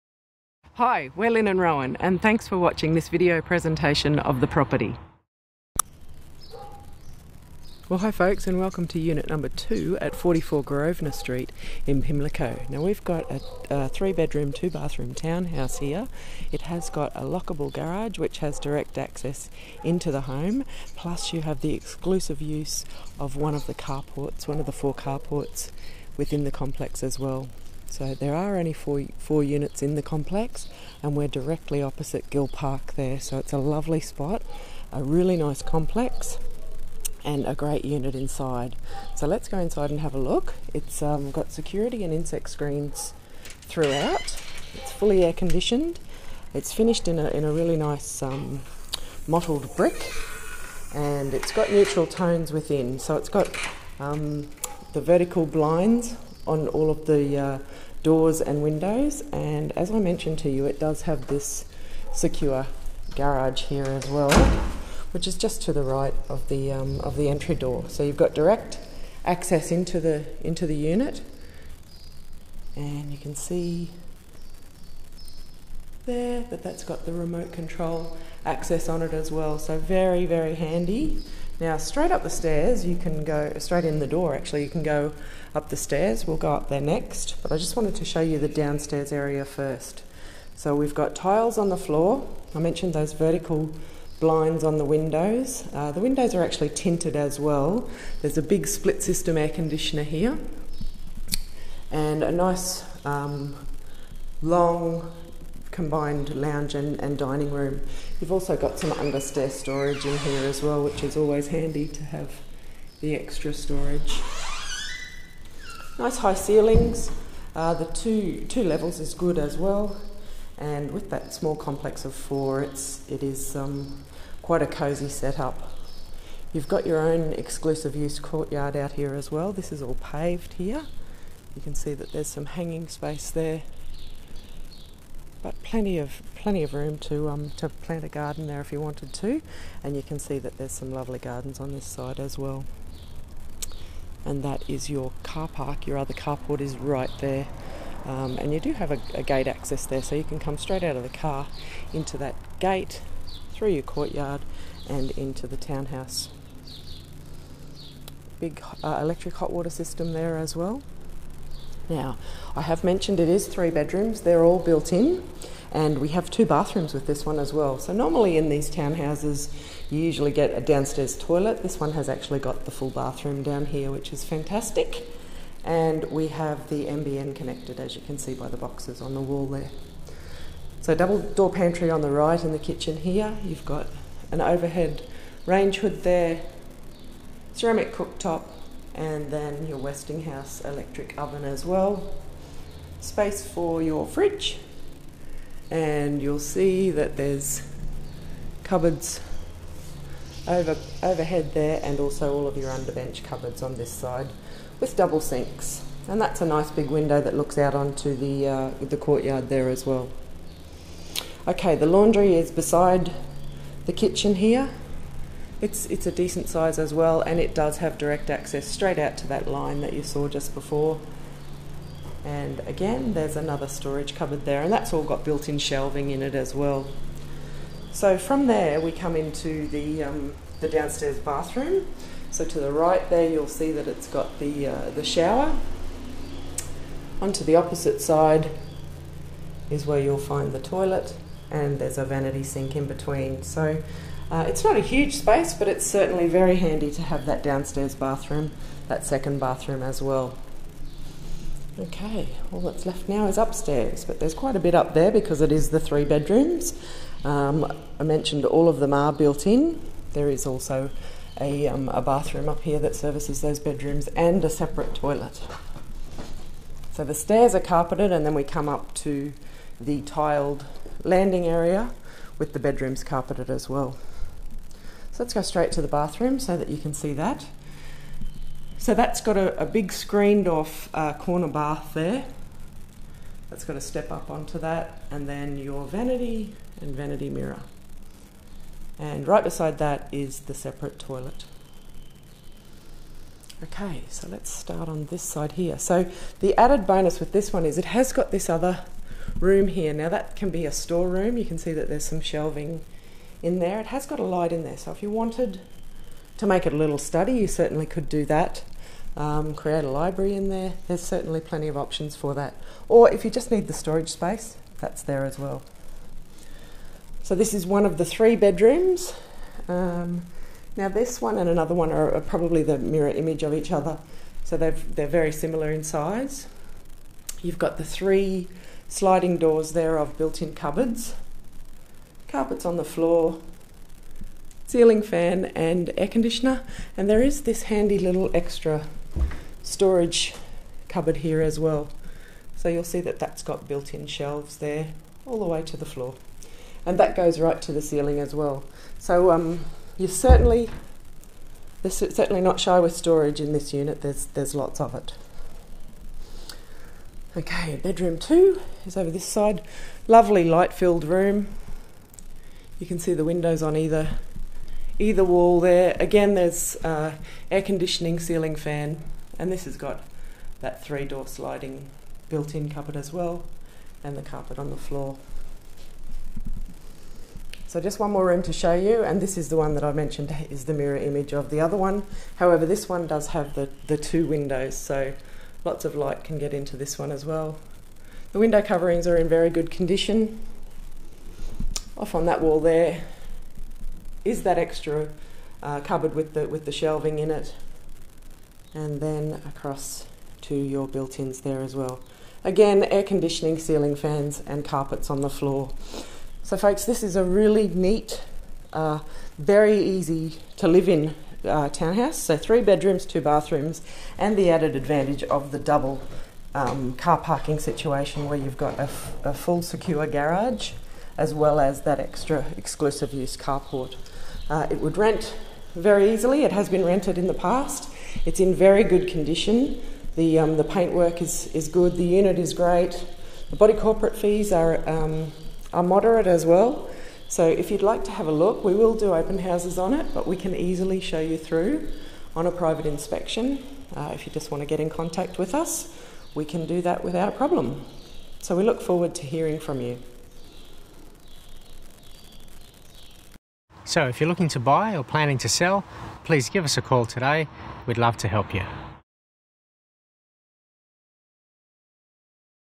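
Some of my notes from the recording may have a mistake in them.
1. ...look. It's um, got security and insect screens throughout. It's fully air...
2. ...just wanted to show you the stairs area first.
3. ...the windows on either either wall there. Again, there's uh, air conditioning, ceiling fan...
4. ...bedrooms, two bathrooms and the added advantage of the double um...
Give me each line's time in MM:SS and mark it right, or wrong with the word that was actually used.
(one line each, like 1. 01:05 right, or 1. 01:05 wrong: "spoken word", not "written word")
1. 00:40 right
2. 01:27 wrong: "downstairs", not "stairs"
3. 06:03 right
4. 06:52 right.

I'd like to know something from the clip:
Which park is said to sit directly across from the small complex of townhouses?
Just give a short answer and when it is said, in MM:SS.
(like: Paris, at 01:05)
Gill Park, at 00:32.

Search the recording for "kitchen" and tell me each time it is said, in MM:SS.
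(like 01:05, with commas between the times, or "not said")
03:02, 03:33.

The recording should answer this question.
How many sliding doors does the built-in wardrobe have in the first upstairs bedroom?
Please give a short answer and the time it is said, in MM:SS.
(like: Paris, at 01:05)
3, at 05:27.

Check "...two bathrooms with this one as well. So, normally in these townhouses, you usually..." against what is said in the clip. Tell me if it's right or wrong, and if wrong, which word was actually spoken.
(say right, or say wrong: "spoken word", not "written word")
right.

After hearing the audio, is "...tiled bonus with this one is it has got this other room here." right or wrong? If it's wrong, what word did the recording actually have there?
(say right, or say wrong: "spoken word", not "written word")
wrong: "added", not "tiled".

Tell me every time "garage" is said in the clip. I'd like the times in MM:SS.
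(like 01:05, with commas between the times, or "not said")
00:17, 01:03, 07:00.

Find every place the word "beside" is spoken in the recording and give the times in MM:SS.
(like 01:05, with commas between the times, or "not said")
03:32, 04:49.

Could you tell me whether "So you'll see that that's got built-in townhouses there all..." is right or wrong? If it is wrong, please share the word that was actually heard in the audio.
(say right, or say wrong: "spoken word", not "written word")
wrong: "shelves", not "townhouses".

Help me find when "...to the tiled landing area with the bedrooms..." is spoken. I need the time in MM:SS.
04:28.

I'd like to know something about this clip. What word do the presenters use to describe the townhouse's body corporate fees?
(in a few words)
Moderate.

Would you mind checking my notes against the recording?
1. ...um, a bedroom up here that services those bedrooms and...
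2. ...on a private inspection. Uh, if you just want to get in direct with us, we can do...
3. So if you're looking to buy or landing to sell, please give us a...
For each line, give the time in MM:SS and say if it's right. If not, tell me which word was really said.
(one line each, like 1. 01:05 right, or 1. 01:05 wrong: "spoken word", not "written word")
1. 04:21 wrong: "bathroom", not "bedroom"
2. 07:22 wrong: "contact", not "direct"
3. 07:33 wrong: "planning", not "landing".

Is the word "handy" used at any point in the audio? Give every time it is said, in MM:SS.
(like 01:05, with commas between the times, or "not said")
01:20, 01:51, 04:06, 05:37.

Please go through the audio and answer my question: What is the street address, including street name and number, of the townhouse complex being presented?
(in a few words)
44 Grosvenor Street.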